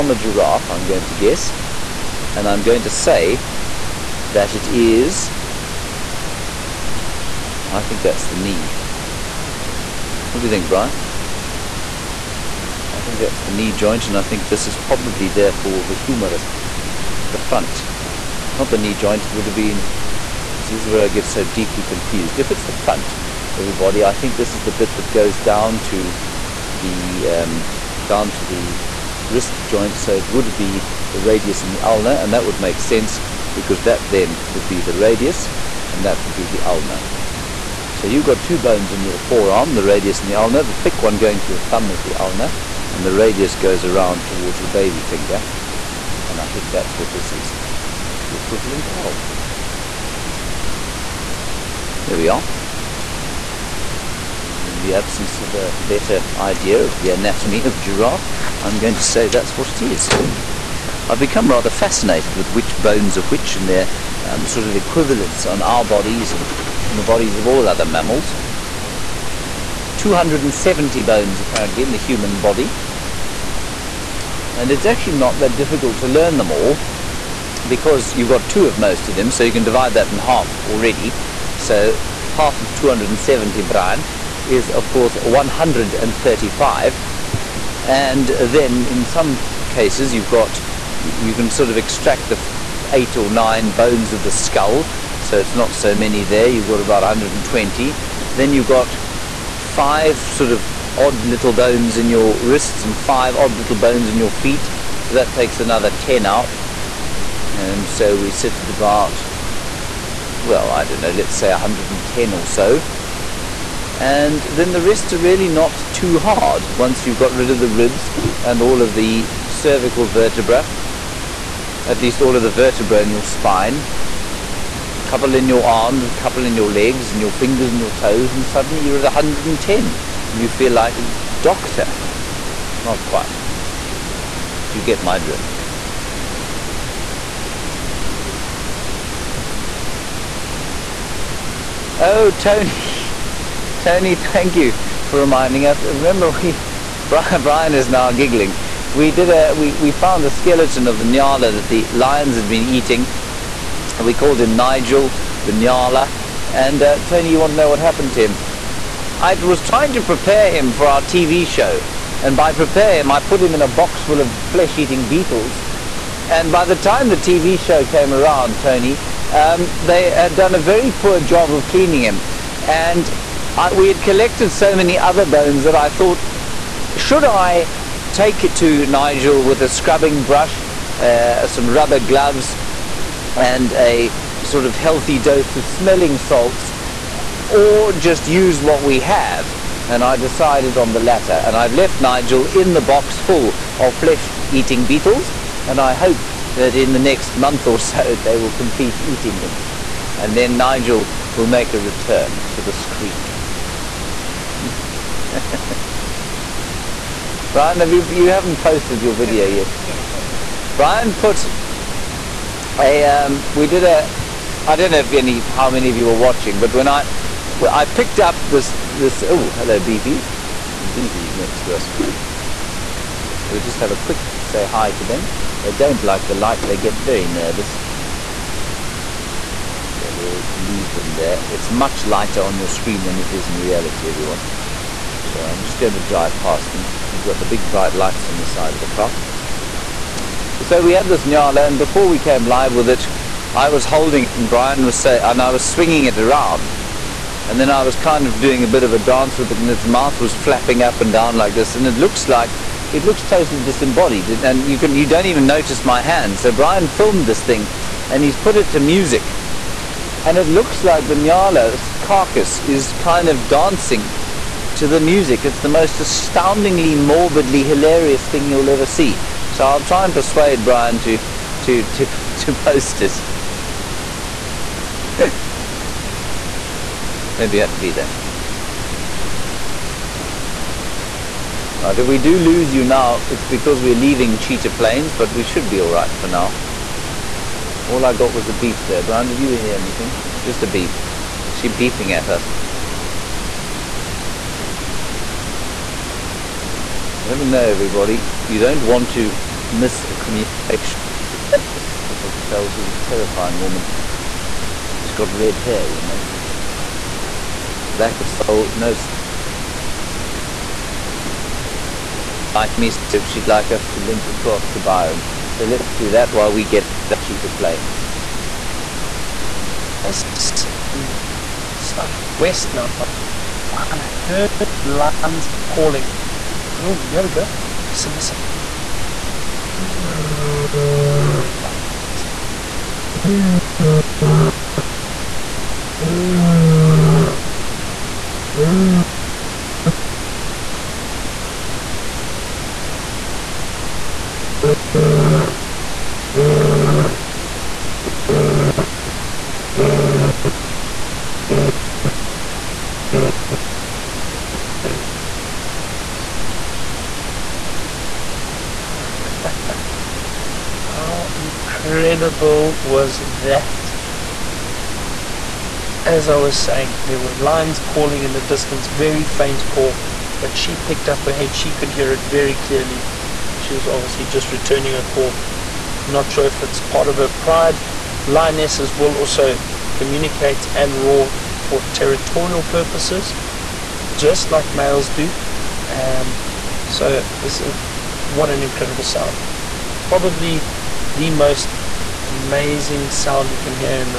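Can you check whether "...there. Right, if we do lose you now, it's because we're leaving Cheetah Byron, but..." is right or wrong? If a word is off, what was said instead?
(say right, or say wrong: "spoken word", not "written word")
wrong: "Plains", not "Byron".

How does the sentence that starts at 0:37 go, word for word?
So you've got two bones in your forearm, the radius and the ulna.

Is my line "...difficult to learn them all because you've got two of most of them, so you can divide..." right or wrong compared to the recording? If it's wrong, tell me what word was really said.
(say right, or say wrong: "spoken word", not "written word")
right.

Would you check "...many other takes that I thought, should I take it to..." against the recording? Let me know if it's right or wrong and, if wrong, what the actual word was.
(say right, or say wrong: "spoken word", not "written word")
wrong: "bones", not "takes".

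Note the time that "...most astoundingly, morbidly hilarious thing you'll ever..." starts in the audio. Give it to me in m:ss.
4:25.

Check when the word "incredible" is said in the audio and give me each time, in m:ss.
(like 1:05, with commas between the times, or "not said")
6:02, 6:28.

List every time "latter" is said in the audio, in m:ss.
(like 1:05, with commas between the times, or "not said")
3:10.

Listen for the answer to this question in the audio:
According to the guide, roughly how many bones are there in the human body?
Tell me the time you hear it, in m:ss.
1:09.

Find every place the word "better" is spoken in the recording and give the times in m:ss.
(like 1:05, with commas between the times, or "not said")
0:55.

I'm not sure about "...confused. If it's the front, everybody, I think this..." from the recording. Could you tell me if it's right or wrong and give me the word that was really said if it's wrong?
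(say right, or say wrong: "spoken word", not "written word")
right.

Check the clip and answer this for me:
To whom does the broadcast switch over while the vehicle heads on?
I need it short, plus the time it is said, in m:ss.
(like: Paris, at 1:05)
Byron, at 5:14.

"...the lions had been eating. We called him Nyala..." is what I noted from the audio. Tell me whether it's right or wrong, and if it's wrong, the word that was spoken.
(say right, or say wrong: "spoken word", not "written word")
wrong: "Nigel", not "Nyala".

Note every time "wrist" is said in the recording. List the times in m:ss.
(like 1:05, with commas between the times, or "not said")
0:29, 1:42.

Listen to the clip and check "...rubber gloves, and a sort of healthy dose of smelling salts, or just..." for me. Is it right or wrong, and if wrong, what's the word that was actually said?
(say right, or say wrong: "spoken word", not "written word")
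right.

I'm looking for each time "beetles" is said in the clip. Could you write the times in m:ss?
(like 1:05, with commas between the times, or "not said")
2:45, 3:14.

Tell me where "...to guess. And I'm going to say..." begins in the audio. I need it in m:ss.
0:01.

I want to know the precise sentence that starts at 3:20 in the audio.
And then Nigel will make a return to the screen.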